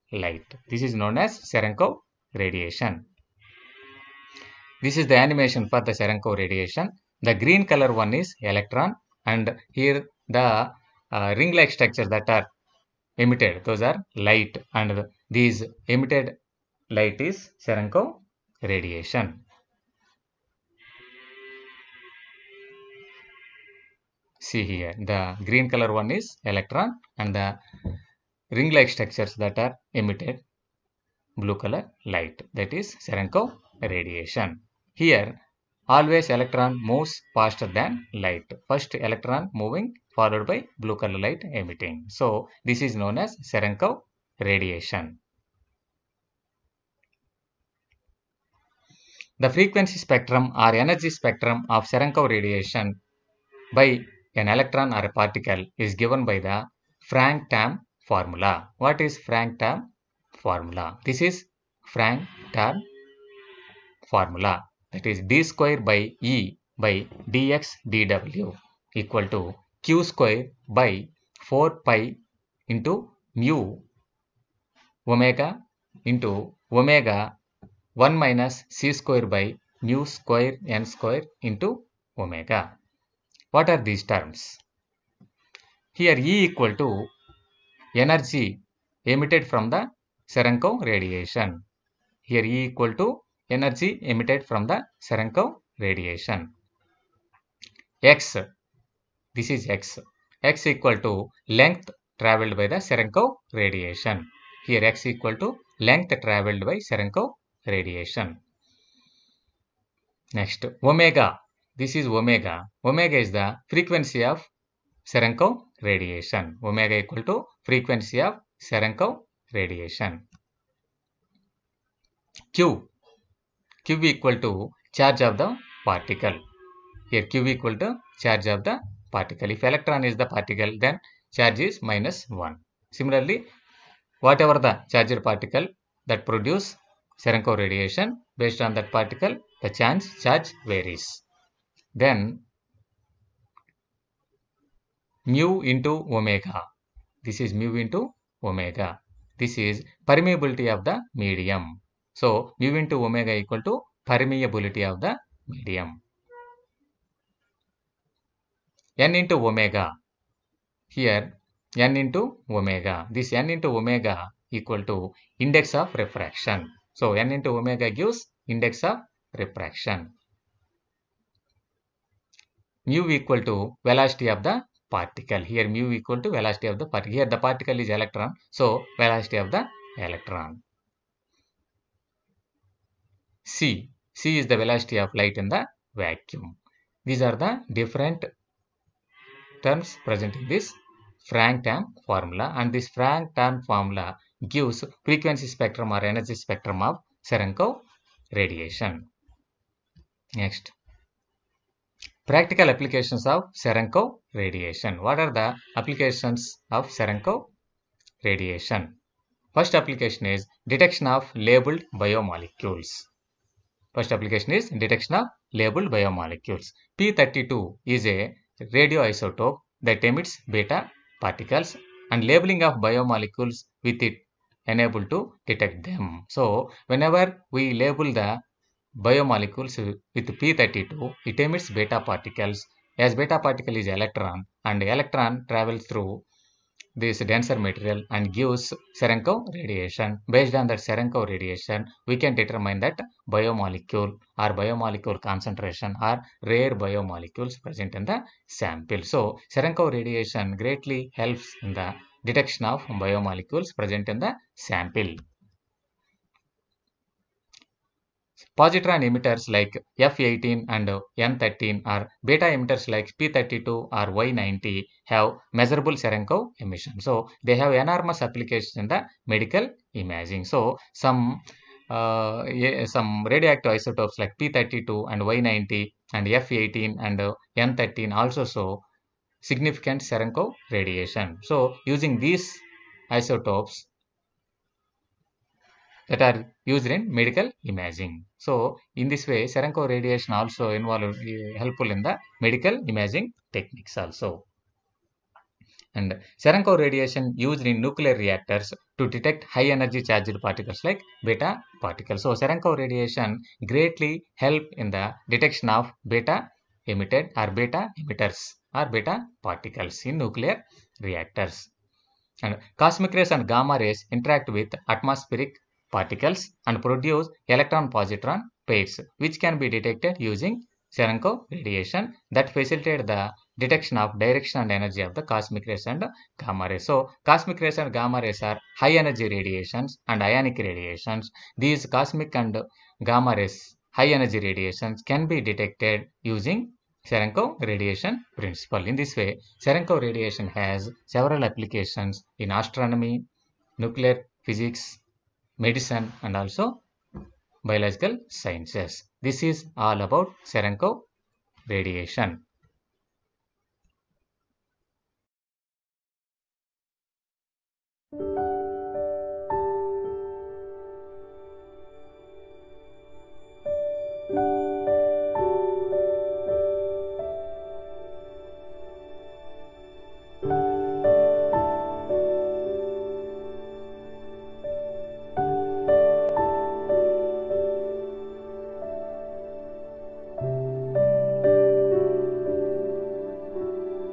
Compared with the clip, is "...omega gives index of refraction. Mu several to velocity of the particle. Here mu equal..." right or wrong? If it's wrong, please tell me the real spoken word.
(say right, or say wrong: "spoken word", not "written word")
wrong: "equal", not "several".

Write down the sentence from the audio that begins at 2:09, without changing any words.
If electron is the particle, then charge is minus 1.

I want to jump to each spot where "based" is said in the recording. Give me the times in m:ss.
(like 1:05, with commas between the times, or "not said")
2:18, 4:00.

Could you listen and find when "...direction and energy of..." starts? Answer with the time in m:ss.
5:24.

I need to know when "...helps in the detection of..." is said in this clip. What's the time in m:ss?
4:11.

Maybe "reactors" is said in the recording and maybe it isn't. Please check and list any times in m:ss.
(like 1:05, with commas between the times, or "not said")
4:58, 5:11.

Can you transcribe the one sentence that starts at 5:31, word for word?
These cosmic and gamma rays high energy radiations can be detected using Cherenkov radiation principle.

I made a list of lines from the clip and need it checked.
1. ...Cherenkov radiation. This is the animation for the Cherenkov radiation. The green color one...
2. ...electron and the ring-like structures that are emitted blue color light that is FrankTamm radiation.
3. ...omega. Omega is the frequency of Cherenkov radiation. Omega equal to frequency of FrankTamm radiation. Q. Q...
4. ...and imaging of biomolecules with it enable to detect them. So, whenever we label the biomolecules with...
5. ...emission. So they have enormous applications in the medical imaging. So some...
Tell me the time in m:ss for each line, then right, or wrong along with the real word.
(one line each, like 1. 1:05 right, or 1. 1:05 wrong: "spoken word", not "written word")
1. 0:01 right
2. 0:26 wrong: "Cherenkov", not "FrankTamm"
3. 1:52 wrong: "Cherenkov", not "FrankTamm"
4. 3:42 wrong: "labeling", not "imaging"
5. 4:26 right.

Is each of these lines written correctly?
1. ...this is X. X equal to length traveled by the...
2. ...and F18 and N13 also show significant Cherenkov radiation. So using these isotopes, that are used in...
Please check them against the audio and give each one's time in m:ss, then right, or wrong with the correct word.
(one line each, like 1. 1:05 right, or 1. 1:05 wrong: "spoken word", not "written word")
1. 1:39 right
2. 4:36 right.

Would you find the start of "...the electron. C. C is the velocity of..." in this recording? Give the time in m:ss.
2:59.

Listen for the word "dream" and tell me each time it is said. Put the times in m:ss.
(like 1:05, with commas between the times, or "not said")
not said.